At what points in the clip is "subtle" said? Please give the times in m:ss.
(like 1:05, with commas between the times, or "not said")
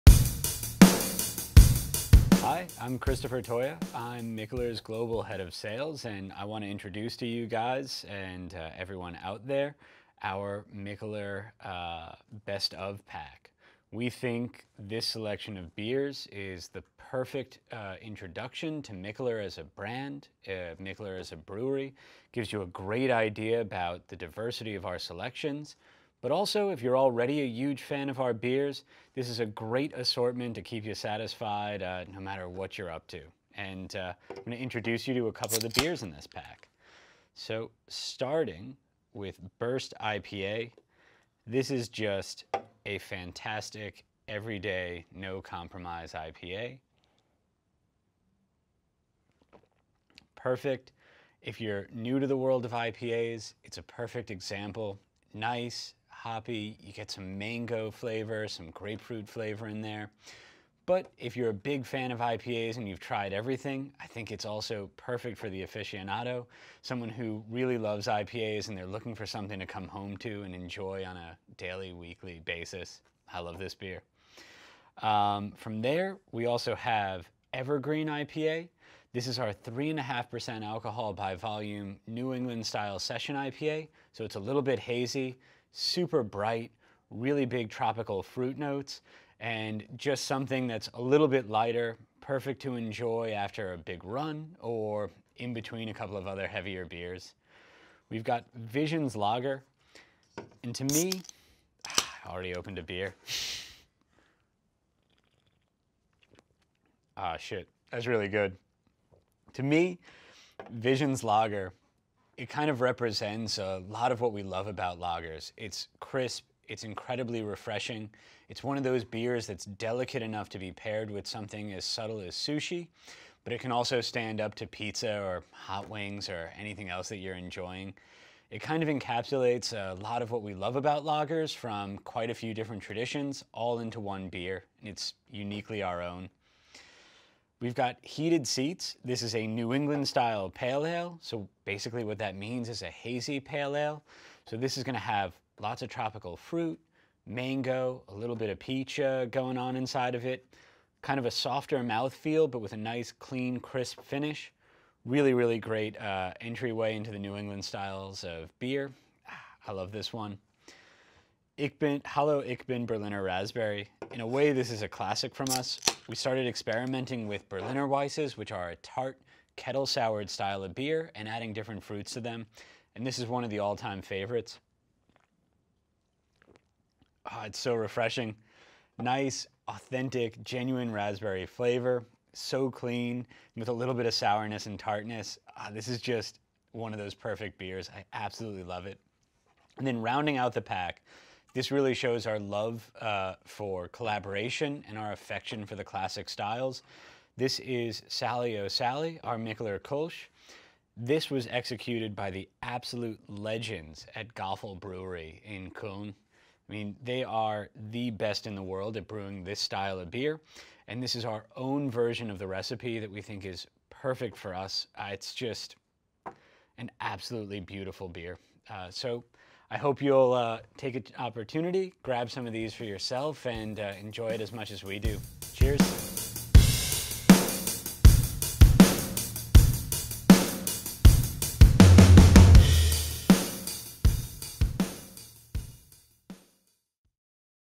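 2:01.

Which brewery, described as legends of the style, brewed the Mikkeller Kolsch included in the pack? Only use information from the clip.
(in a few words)
Gaffel Brewery.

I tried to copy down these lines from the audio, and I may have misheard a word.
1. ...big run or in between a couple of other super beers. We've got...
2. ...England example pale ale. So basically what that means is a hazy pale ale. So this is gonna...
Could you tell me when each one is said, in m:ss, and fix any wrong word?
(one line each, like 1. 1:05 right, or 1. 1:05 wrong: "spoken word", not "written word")
1. 1:33 wrong: "heavier", not "super"
2. 2:19 wrong: "style", not "example".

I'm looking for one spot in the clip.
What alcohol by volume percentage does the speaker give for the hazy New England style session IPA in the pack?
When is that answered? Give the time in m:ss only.
1:19.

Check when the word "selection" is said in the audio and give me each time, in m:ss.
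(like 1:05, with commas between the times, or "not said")
0:15, 0:24.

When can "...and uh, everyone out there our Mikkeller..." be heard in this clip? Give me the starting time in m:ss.
0:08.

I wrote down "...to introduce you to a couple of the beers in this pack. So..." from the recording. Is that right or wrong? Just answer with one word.
right.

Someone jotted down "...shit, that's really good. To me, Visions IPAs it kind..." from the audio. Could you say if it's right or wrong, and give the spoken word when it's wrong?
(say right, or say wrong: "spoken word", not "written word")
wrong: "Lager", not "IPAs".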